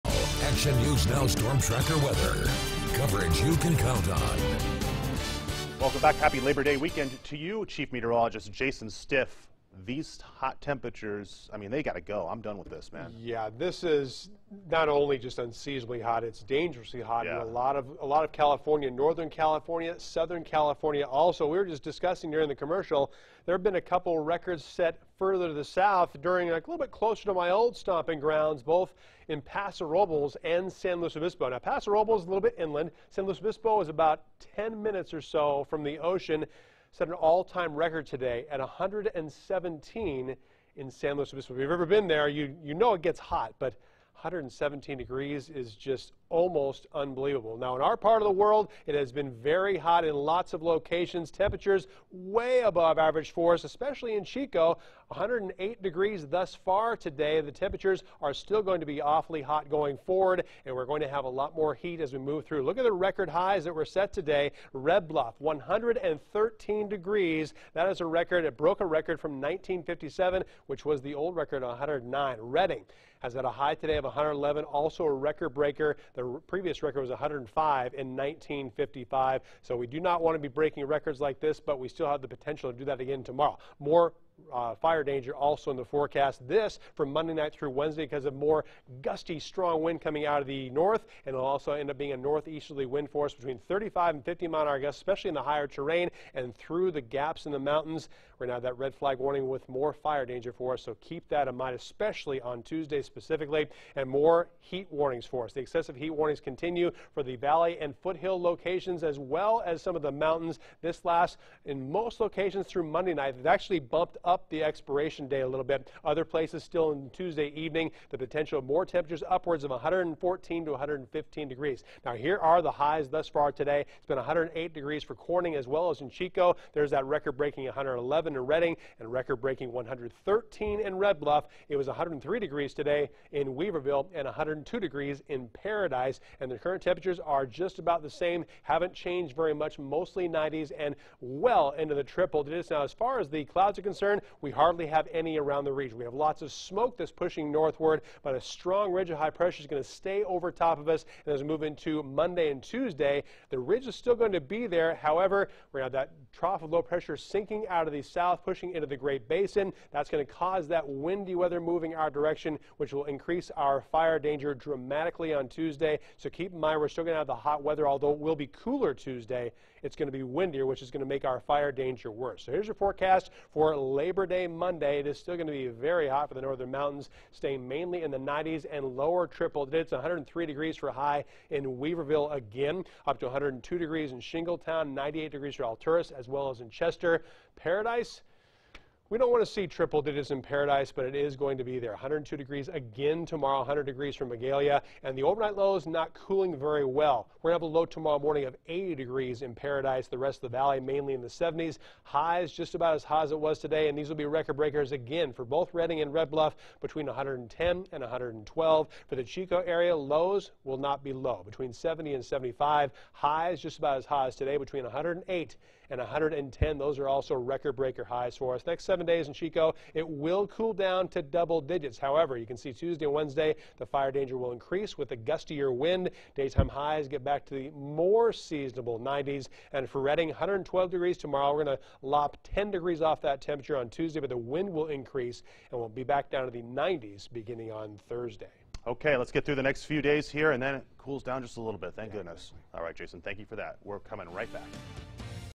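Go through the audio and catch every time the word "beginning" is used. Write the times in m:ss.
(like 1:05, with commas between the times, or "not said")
3:57.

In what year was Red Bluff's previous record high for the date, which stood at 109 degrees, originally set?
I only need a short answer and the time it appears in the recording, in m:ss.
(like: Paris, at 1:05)
1957, at 1:09.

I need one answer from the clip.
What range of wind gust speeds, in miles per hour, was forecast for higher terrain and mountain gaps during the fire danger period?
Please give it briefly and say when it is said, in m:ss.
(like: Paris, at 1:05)
35 to 50, at 1:33.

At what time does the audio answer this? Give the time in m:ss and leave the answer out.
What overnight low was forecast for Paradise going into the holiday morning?
3:18.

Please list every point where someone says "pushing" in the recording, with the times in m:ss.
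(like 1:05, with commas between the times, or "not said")
2:27, 2:38.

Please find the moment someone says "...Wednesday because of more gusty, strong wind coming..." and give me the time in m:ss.
1:27.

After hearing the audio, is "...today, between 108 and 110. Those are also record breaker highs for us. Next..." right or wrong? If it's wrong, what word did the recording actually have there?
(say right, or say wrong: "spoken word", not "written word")
right.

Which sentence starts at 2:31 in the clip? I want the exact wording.
And as we move into Monday and Tuesday, the ridge is still going to be there.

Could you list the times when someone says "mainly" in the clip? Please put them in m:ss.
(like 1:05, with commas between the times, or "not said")
2:57, 3:20.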